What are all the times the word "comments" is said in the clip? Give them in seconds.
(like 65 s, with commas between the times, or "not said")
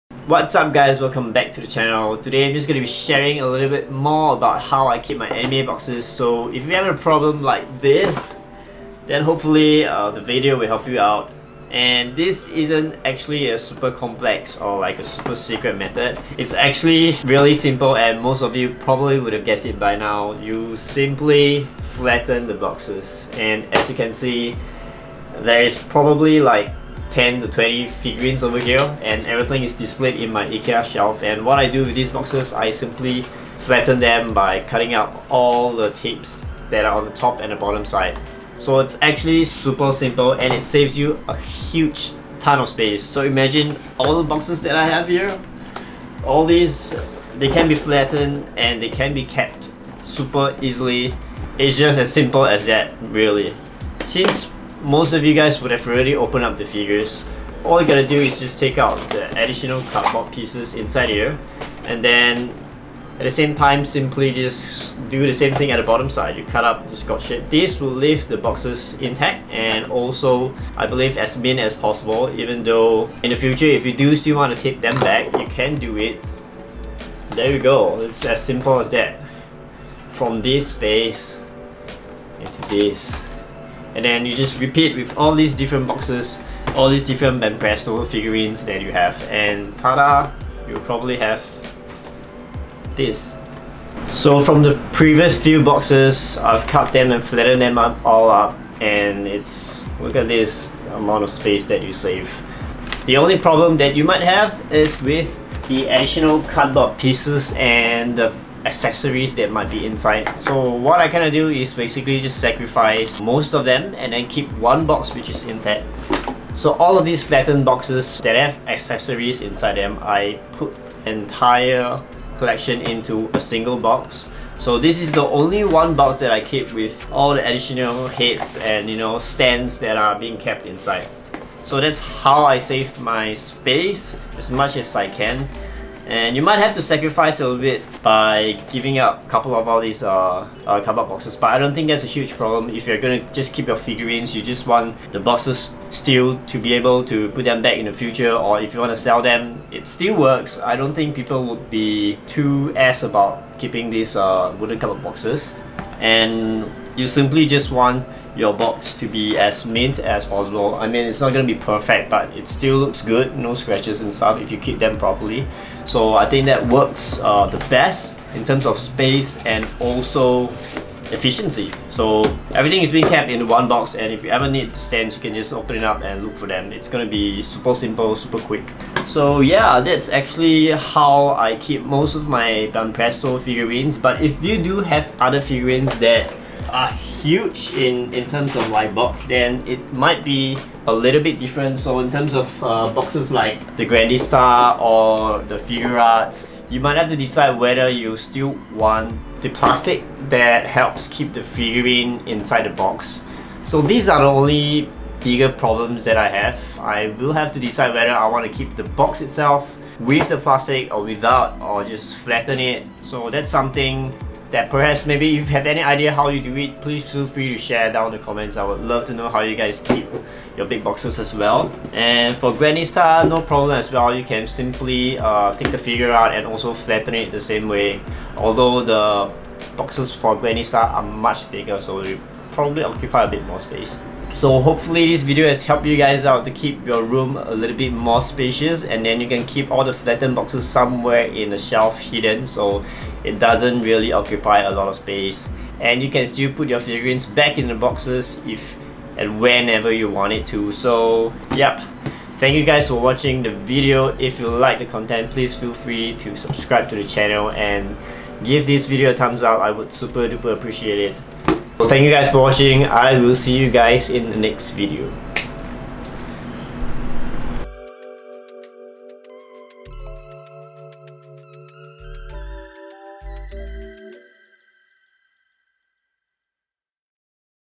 218 s.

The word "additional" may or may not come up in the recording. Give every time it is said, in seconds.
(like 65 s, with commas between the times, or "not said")
59 s, 105 s, 127 s.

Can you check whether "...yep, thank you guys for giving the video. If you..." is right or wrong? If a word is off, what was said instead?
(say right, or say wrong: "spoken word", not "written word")
wrong: "watching", not "giving".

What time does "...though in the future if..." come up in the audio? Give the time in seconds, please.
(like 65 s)
72 s.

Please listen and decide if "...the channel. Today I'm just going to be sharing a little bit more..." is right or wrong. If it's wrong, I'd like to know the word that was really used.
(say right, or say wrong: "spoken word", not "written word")
right.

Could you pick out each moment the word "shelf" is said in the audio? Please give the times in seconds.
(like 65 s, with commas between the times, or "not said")
30 s, 241 s.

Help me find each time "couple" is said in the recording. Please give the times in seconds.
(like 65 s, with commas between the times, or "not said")
139 s.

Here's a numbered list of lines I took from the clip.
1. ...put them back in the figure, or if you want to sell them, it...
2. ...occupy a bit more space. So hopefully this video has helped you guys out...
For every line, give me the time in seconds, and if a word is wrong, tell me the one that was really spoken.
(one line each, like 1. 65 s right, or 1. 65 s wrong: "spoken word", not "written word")
1. 147 s wrong: "future", not "figure"
2. 232 s right.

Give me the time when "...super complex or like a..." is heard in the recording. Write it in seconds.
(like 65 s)
13 s.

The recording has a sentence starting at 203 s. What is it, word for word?
So these are the only bigger problems that I have.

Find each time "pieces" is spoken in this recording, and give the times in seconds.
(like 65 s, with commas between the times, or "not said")
60 s, 106 s.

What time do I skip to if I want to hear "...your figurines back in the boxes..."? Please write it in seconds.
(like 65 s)
246 s.